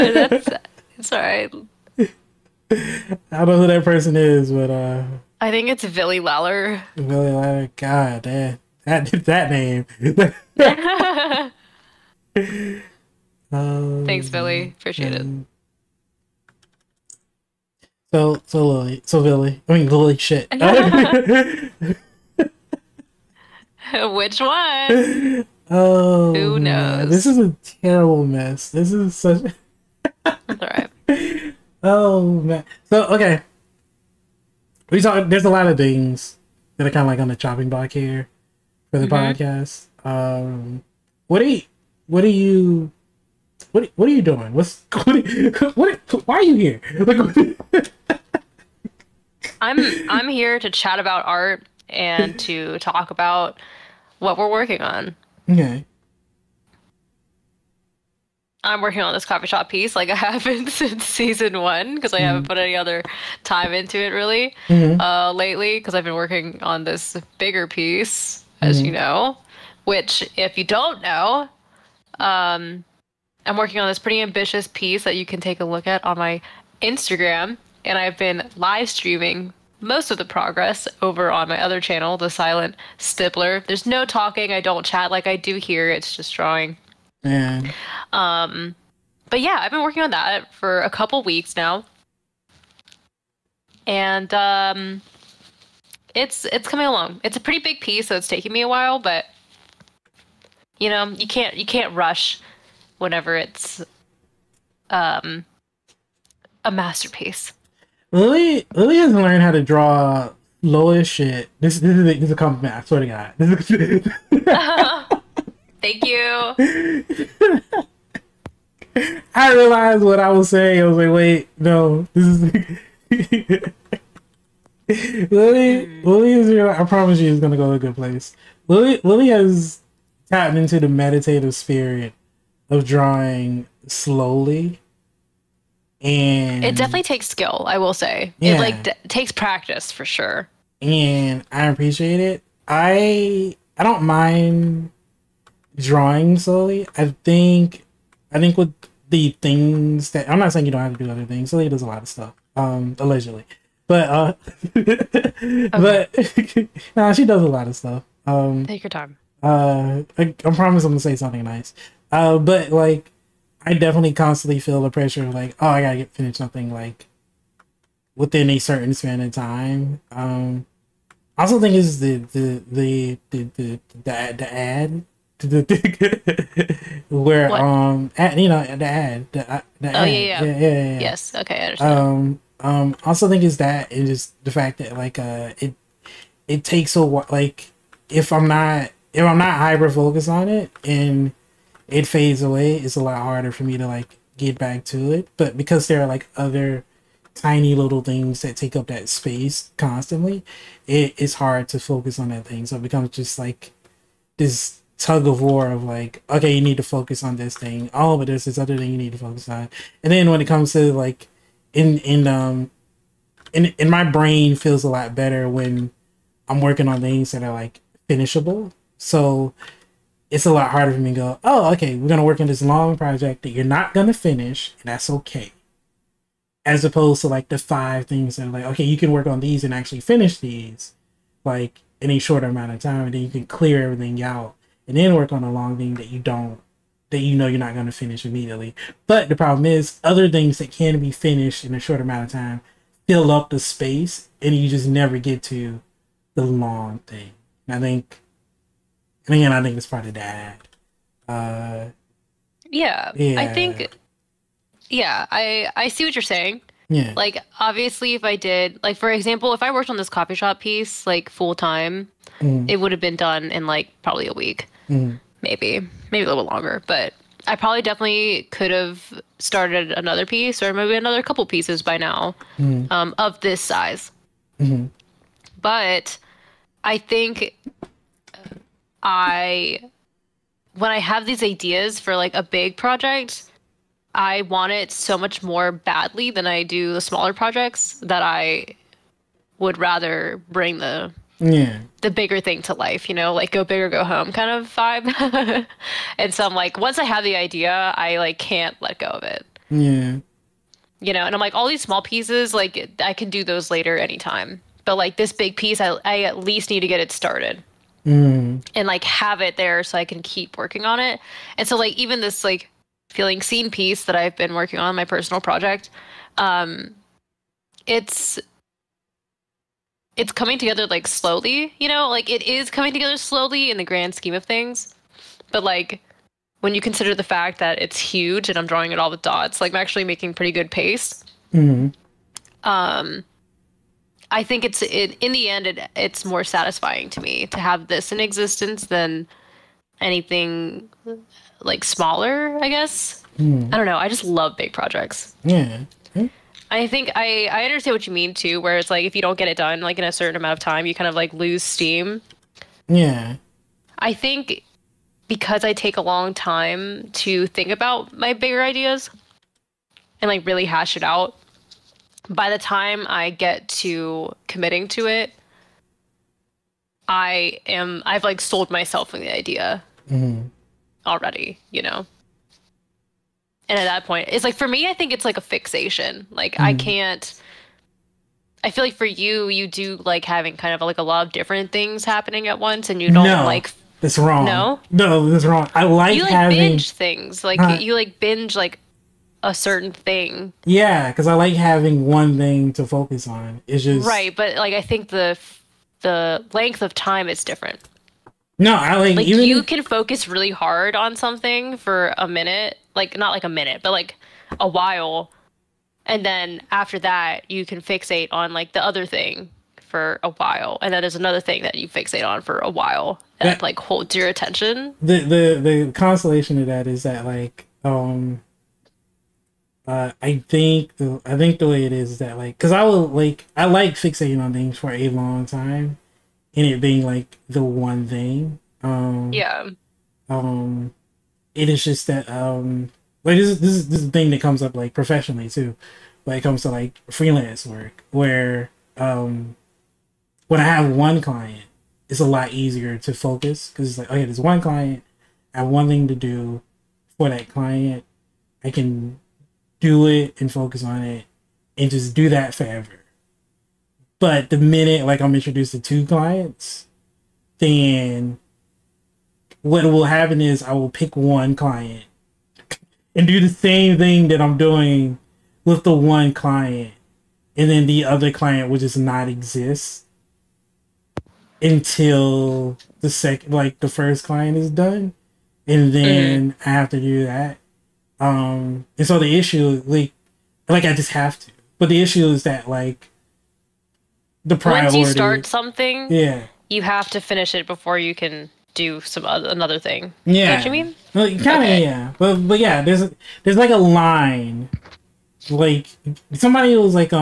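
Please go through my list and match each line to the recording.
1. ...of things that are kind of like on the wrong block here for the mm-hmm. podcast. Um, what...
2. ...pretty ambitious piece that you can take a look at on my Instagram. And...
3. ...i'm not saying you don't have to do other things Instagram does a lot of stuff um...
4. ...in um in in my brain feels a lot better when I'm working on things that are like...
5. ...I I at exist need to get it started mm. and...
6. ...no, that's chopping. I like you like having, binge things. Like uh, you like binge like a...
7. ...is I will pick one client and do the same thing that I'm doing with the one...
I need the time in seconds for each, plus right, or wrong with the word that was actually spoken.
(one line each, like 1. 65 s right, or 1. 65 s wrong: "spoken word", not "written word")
1. 35 s wrong: "chopping", not "wrong"
2. 73 s right
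3. 150 s wrong: "Slowly", not "Instagram"
4. 211 s right
5. 305 s wrong: "least", not "exist"
6. 384 s wrong: "wrong", not "chopping"
7. 460 s right.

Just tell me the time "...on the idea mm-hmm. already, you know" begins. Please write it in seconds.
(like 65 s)
369 s.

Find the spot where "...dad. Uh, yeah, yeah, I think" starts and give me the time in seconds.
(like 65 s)
250 s.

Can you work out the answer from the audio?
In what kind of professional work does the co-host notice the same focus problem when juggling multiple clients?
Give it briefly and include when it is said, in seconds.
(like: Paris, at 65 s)
freelance work, at 437 s.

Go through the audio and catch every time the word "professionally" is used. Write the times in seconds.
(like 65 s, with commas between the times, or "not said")
434 s.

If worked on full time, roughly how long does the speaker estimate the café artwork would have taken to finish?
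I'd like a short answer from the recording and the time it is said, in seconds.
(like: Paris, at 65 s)
a week, at 264 s.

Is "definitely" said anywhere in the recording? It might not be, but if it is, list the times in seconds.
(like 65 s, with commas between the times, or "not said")
136 s, 163 s, 267 s.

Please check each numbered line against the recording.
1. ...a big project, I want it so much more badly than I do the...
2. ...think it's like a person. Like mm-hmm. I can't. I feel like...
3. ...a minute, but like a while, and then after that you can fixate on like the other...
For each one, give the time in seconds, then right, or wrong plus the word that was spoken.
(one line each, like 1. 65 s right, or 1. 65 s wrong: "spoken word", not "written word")
1. 282 s right
2. 374 s wrong: "fixation", not "person"
3. 403 s right.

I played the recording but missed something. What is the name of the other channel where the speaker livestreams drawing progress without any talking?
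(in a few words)
The Silent Stippler.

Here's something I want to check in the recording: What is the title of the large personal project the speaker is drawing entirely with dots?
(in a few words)
Feeling Seen.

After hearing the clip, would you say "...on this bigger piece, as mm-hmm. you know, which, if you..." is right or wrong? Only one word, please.
right.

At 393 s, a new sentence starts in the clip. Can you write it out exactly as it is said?
It's just right, but like I think the the length of time is different.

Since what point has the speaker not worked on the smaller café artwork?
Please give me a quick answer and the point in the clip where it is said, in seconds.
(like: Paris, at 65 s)
season one, at 61 s.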